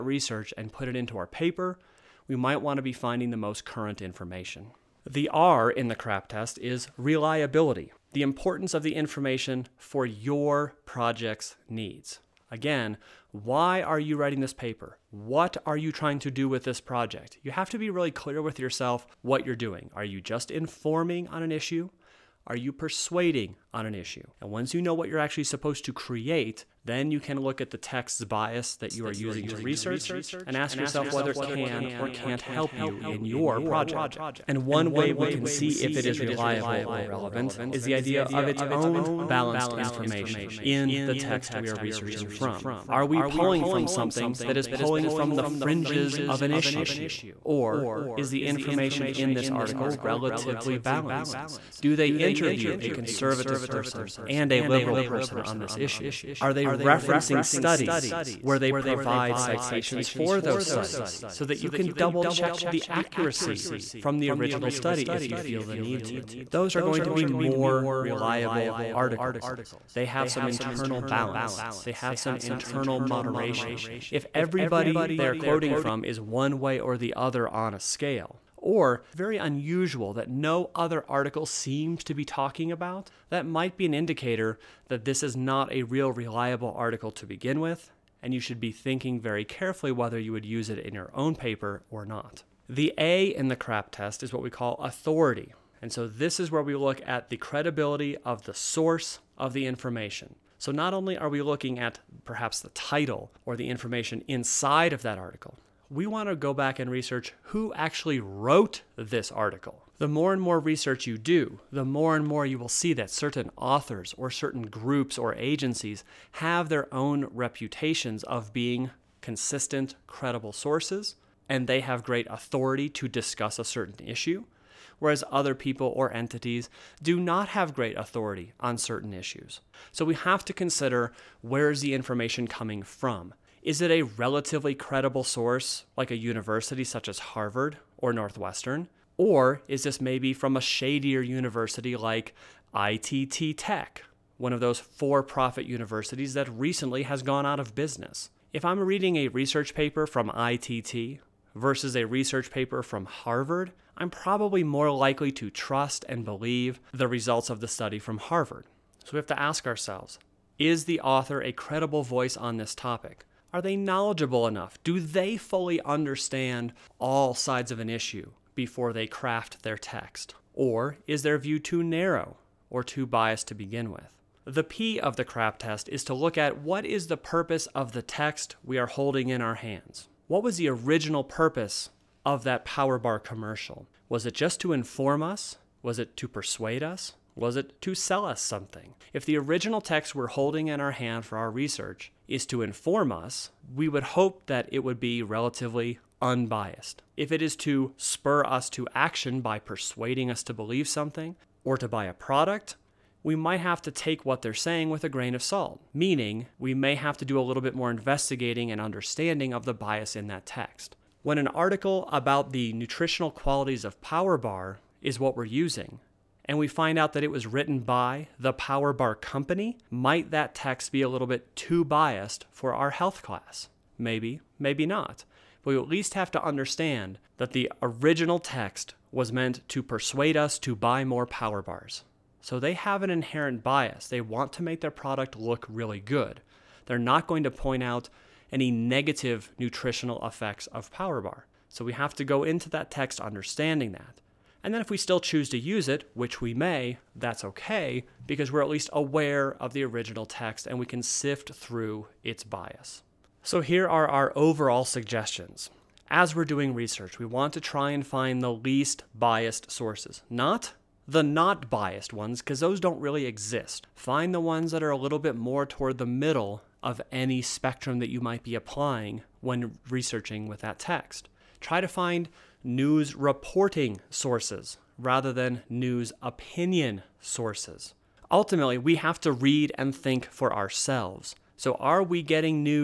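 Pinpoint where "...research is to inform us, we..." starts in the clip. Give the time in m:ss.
3:11.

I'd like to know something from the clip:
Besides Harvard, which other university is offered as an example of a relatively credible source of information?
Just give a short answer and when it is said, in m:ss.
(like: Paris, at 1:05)
Northwestern, at 2:18.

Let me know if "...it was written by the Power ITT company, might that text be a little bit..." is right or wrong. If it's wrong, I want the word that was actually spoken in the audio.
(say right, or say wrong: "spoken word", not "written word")
wrong: "Bar", not "ITT".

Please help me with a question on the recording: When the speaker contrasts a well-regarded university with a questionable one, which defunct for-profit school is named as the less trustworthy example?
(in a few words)
ITT Tech.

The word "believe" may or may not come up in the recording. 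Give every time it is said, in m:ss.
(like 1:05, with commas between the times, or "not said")
2:36, 3:20.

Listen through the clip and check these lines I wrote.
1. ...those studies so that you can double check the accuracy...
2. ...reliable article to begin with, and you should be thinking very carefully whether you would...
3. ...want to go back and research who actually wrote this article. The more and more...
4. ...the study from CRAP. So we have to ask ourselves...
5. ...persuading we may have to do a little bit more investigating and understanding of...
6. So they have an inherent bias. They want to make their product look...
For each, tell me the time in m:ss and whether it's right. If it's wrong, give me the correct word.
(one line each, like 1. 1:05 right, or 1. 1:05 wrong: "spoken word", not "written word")
1. 1:00 right
2. 1:26 right
3. 1:46 right
4. 2:37 wrong: "Harvard", not "CRAP"
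5. 3:25 wrong: "meaning", not "persuading"
6. 3:52 right.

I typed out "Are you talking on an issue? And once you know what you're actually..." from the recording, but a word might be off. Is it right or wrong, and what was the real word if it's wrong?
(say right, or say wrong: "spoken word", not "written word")
wrong: "persuading", not "talking".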